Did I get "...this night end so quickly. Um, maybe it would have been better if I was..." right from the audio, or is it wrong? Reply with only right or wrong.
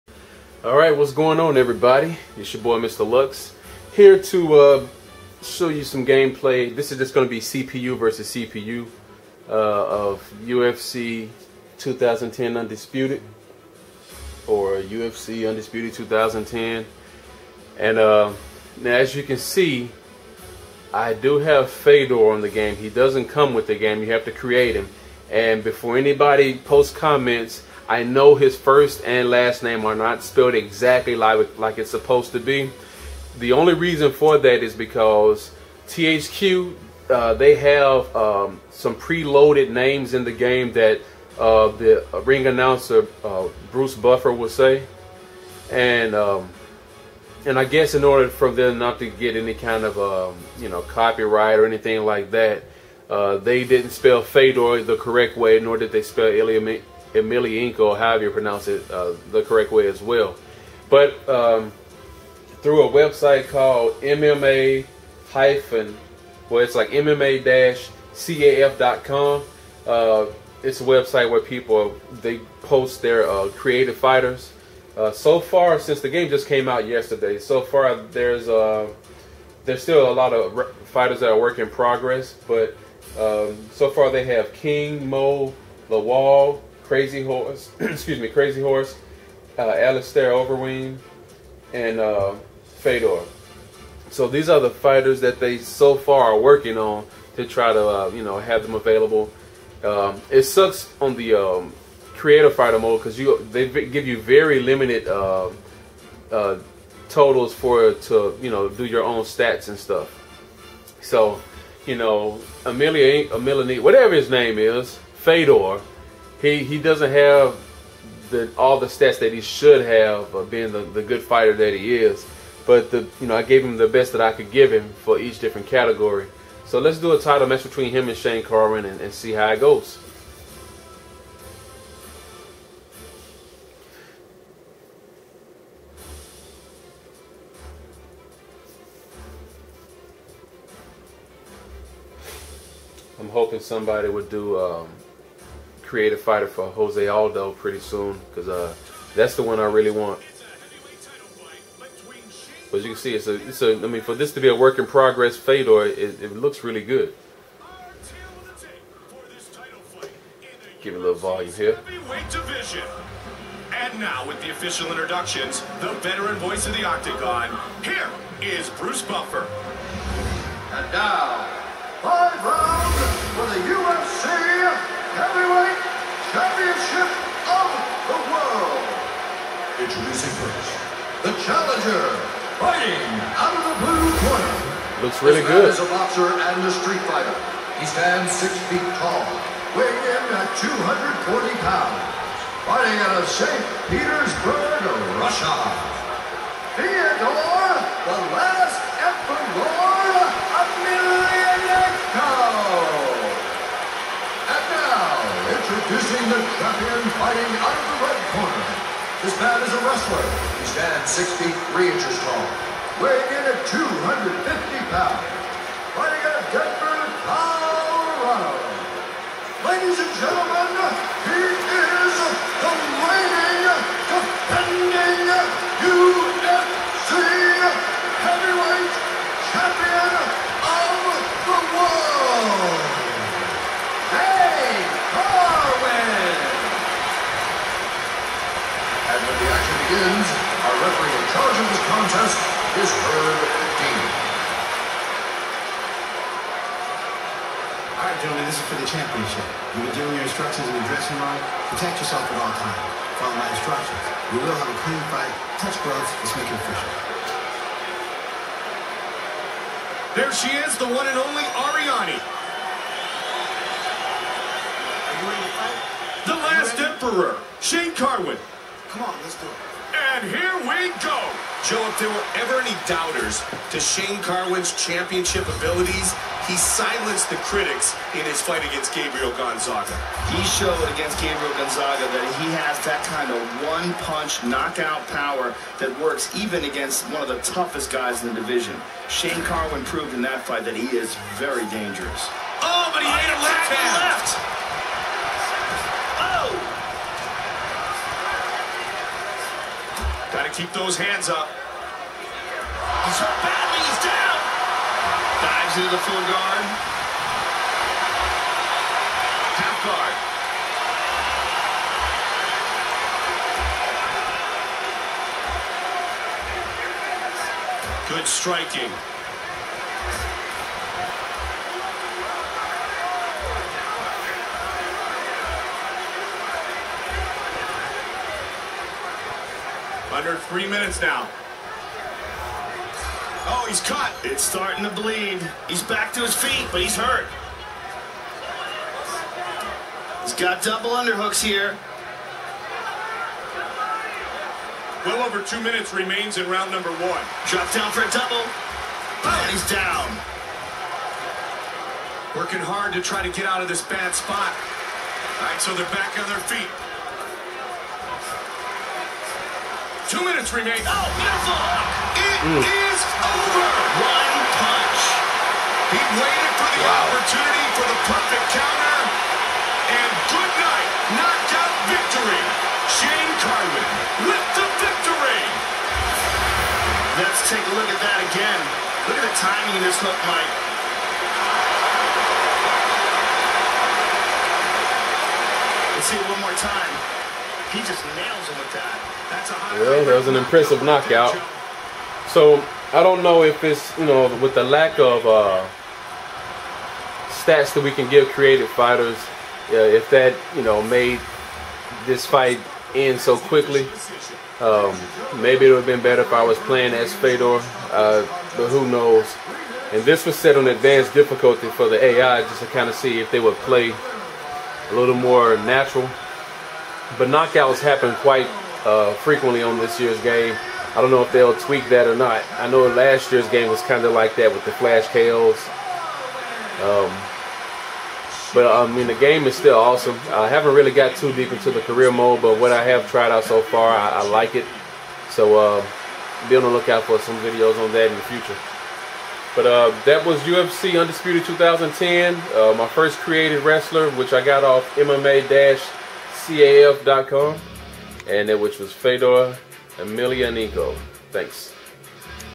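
wrong.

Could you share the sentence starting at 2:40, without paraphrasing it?
Give it a little volume here.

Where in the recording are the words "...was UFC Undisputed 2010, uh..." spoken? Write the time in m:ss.
7:20.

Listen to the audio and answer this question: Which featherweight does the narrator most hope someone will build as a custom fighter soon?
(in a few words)
Jose Aldo.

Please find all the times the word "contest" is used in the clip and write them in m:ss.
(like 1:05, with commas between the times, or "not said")
4:01.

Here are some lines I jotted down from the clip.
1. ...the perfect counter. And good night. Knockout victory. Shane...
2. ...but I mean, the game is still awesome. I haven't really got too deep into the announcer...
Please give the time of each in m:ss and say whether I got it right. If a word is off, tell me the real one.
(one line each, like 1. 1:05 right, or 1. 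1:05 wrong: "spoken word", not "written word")
1. 6:07 right
2. 7:08 wrong: "career", not "announcer".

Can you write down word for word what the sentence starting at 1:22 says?
But um, so far they have King, Mo, Lawal.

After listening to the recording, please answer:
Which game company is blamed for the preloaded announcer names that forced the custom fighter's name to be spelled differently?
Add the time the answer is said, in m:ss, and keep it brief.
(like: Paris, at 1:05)
THQ, at 0:35.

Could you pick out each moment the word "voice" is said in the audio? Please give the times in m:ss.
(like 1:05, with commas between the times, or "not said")
2:46.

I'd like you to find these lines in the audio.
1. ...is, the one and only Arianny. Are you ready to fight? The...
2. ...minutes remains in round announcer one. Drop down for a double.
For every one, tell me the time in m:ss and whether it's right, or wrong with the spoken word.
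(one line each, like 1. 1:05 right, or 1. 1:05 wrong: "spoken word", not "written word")
1. 4:20 right
2. 5:45 wrong: "number", not "announcer".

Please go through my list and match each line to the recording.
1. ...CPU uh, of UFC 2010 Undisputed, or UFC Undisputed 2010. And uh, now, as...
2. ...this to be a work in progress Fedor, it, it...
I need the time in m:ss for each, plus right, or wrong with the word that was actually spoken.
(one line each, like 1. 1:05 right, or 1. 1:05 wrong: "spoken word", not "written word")
1. 0:08 right
2. 2:34 right.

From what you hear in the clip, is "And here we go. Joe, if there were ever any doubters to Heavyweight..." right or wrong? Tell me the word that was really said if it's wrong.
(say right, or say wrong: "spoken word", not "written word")
wrong: "Shane", not "Heavyweight".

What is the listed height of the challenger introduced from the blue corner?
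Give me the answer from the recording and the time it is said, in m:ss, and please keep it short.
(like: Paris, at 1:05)
six feet, at 3:08.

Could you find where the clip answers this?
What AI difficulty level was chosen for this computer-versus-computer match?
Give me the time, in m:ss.
6:50.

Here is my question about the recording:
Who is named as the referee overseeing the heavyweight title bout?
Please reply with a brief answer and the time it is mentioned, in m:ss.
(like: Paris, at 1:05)
Herb Dean, at 4:02.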